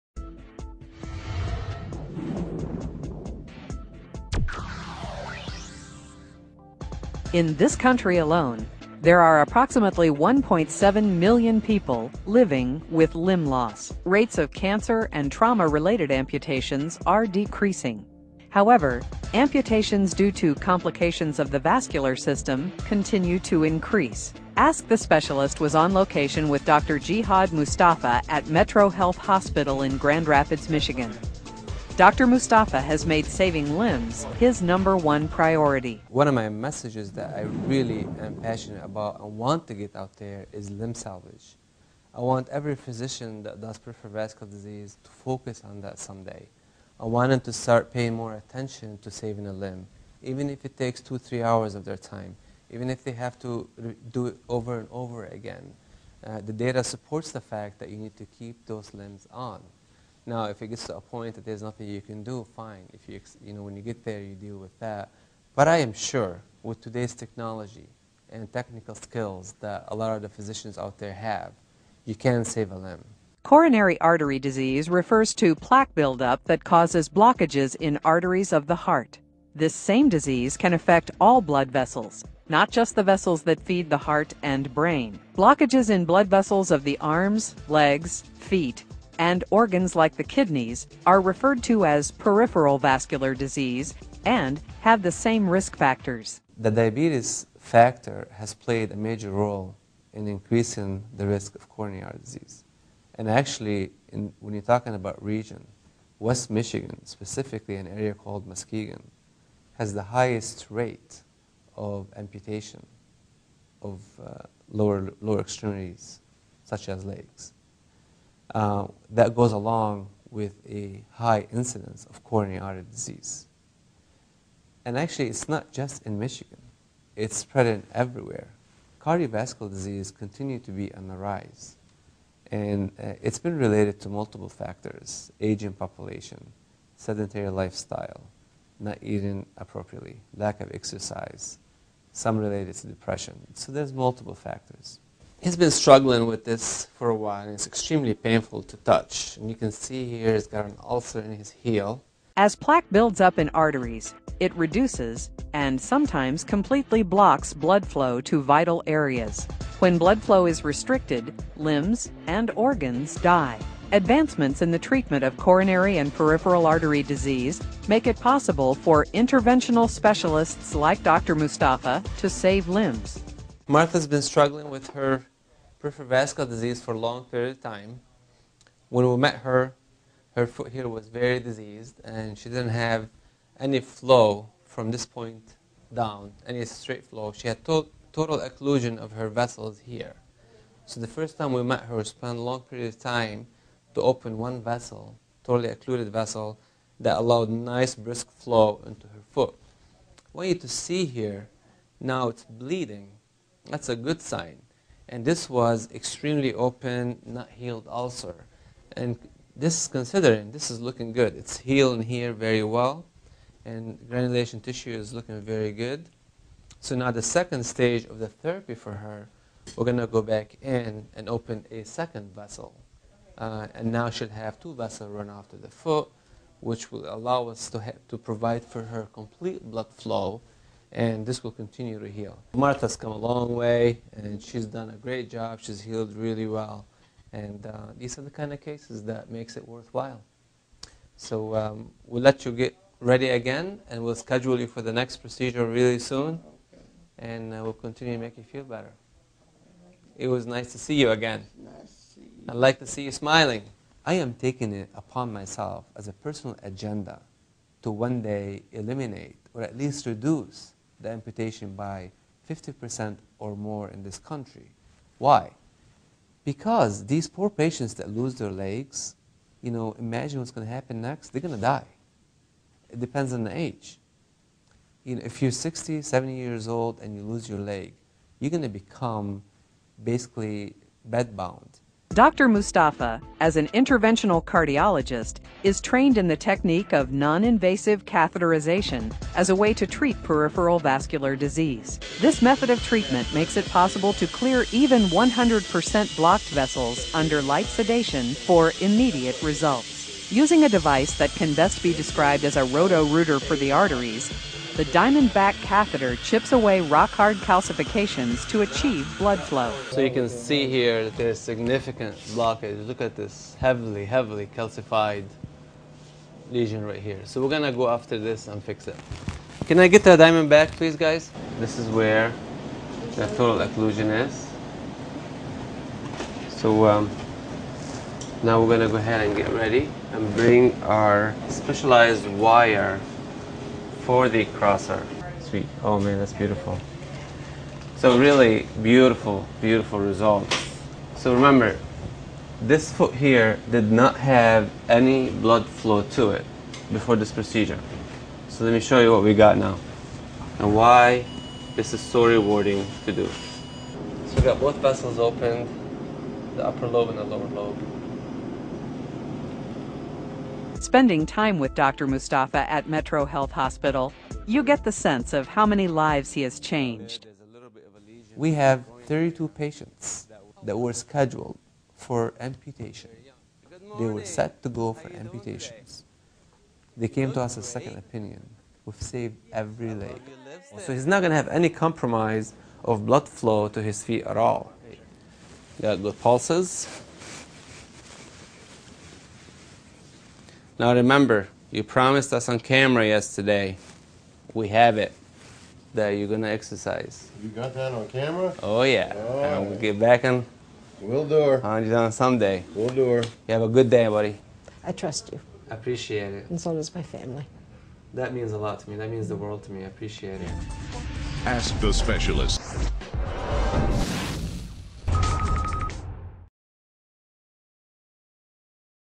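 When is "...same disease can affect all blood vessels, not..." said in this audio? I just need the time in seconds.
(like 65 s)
79 s.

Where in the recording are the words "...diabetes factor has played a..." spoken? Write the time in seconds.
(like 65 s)
96 s.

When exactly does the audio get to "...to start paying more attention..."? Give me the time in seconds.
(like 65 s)
47 s.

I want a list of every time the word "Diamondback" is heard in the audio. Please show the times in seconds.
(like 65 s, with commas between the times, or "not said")
304 s, 320 s.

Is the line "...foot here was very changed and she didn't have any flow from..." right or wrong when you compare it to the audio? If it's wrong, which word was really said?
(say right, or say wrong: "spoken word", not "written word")
wrong: "diseased", not "changed".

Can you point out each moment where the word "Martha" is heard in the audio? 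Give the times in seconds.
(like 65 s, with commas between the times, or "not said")
173 s, 232 s.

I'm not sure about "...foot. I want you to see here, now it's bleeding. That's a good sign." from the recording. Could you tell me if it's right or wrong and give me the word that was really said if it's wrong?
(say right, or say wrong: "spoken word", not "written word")
right.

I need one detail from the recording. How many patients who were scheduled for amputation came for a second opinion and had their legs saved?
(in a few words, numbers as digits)
32.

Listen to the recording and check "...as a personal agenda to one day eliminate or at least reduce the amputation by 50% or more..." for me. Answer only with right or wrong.
right.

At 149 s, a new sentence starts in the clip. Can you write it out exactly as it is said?
And you can see here he's got an ulcer in his heel.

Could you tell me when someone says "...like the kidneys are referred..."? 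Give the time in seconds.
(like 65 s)
89 s.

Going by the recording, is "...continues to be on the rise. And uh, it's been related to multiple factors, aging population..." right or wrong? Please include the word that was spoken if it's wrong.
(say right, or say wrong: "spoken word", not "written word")
right.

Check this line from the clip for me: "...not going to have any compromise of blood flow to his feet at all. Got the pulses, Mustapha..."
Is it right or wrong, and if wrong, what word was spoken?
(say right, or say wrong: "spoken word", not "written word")
wrong: "Now", not "Mustapha".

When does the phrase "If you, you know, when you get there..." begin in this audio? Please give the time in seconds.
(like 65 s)
62 s.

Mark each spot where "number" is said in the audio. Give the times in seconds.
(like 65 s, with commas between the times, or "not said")
34 s.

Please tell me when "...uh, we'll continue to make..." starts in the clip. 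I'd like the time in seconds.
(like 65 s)
247 s.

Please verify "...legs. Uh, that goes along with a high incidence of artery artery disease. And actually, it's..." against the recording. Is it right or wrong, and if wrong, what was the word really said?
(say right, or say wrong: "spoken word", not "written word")
wrong: "coronary", not "artery".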